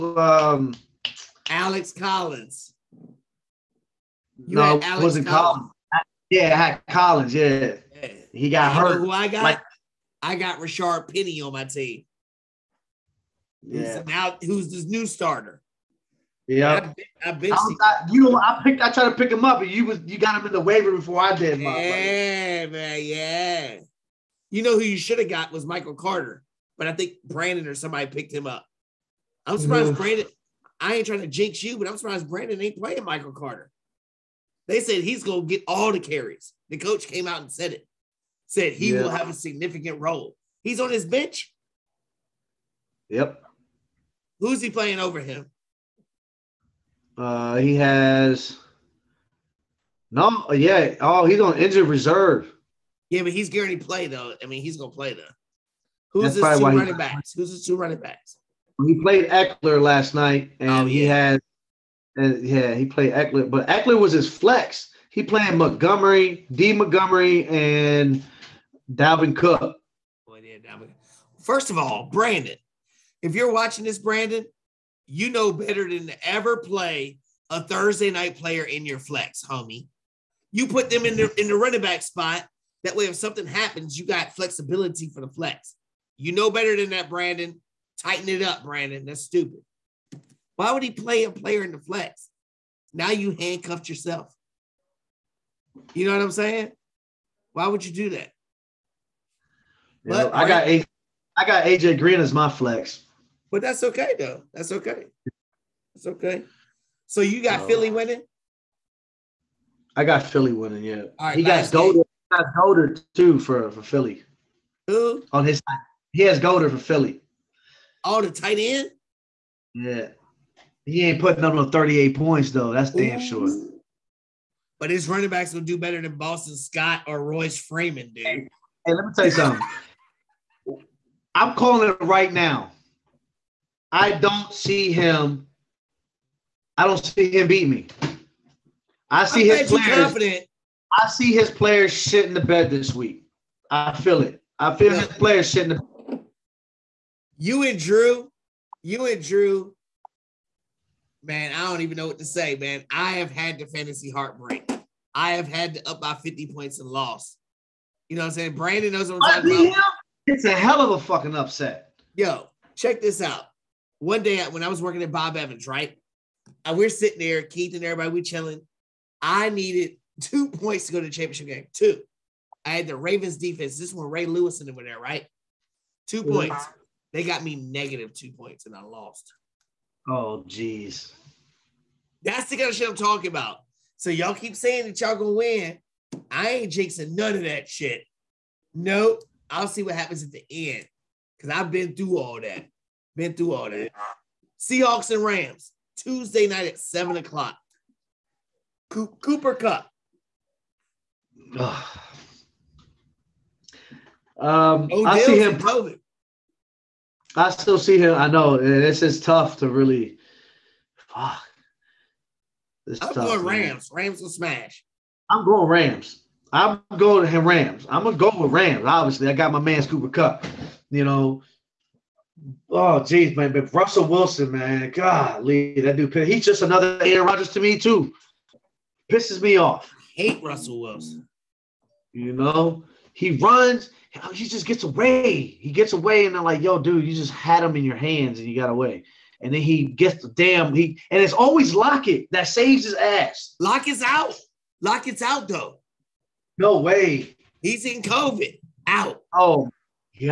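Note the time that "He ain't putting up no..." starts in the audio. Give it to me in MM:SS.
02:00.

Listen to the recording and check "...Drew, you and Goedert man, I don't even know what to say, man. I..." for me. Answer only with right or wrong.
wrong.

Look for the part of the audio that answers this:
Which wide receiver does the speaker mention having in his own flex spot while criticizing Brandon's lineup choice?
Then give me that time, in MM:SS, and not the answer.
01:41.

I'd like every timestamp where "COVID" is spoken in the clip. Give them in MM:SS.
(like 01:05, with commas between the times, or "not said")
03:25, 04:08.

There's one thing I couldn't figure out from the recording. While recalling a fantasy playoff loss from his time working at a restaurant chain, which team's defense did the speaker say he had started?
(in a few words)
Ravens.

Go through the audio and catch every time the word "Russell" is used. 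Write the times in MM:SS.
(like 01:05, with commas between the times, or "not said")
03:43, 03:50.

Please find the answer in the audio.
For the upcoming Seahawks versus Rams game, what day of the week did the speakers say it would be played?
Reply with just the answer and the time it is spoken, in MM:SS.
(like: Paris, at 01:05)
Tuesday, at 03:15.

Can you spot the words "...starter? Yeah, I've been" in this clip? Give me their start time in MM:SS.
00:15.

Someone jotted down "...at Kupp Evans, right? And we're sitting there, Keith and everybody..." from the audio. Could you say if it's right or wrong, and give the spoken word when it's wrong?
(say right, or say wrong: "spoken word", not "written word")
wrong: "Bob", not "Kupp".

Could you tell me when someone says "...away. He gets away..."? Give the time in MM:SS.
03:54.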